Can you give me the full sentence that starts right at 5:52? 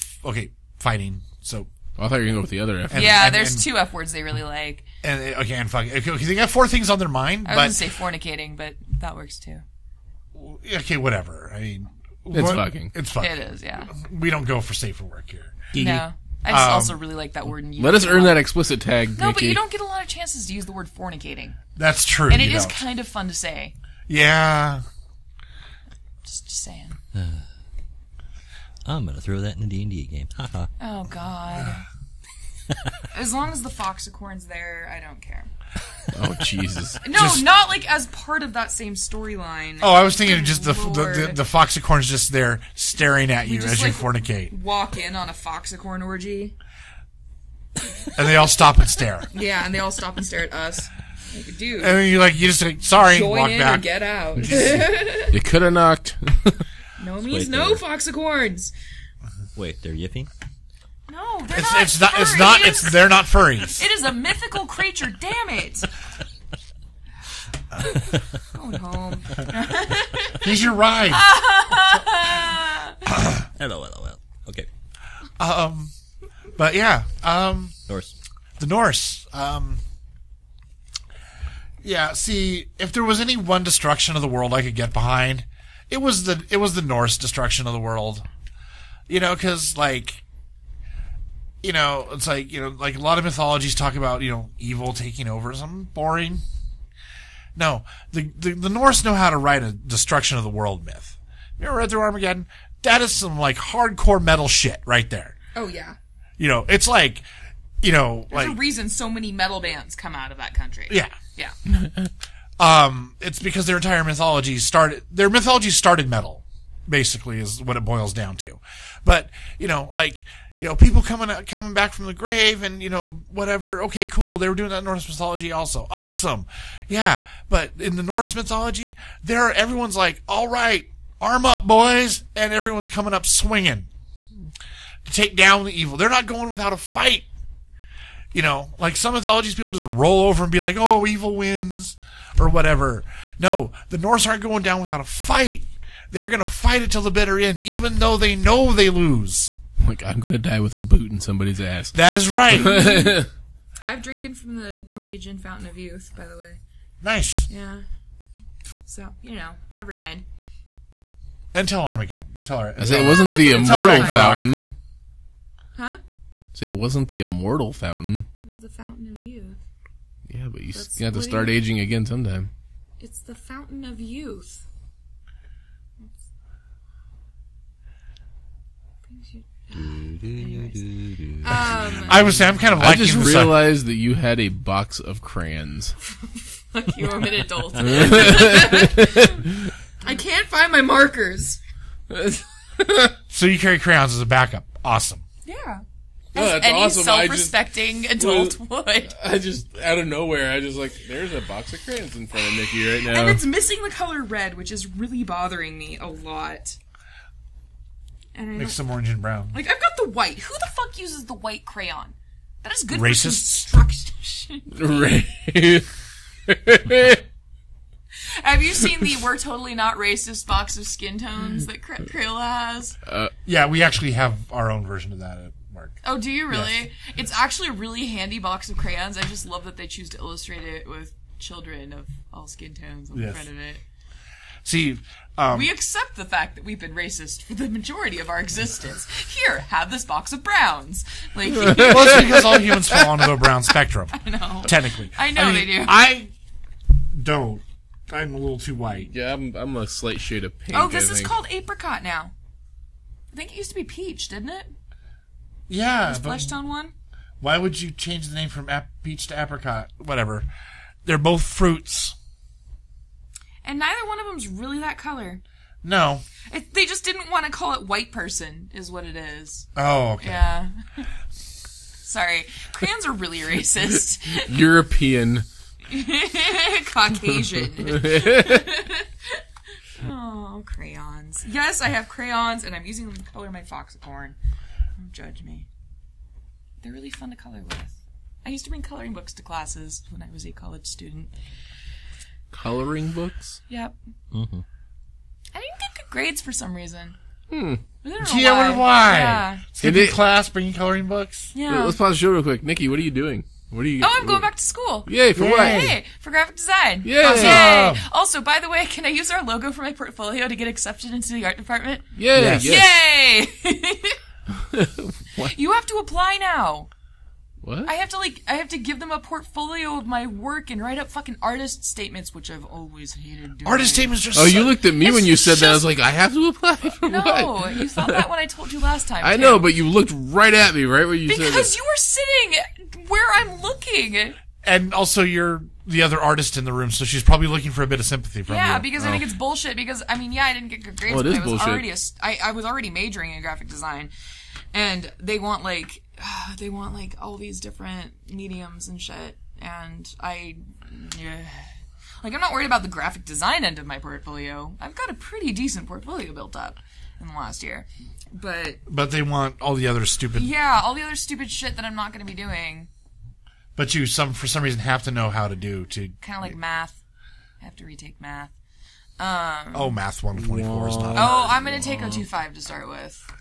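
Like I'm not worried about the graphic design end of my portfolio.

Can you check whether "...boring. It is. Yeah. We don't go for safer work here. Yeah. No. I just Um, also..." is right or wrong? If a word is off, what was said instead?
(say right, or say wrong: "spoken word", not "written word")
wrong: "fucking", not "boring".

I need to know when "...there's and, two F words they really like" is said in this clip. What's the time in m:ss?
0:03.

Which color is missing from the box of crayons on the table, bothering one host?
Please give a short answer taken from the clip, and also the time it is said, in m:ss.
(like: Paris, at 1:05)
red, at 3:24.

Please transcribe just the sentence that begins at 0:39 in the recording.
Oh, I was thinking of just the, the, the the foxicorn's just there staring at you just, as like, you fornicate.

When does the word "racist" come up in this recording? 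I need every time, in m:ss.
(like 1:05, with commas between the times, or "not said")
3:33, 3:39, 3:56, 4:33.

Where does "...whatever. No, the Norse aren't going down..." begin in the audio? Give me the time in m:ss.
2:22.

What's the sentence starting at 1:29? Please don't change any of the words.
You know, because like you know, it's like you know, like a lot of mythologies talk about you know evil taking over.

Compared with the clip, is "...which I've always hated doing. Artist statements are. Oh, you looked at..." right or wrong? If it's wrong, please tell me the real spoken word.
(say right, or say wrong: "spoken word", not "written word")
right.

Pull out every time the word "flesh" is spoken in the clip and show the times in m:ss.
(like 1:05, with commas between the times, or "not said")
4:16.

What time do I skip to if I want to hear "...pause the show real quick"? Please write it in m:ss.
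5:01.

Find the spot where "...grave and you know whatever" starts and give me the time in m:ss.
2:02.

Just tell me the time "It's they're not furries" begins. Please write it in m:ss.
1:02.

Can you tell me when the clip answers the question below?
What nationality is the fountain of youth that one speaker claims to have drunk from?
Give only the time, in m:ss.
2:34.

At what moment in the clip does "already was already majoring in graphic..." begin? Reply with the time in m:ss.
5:42.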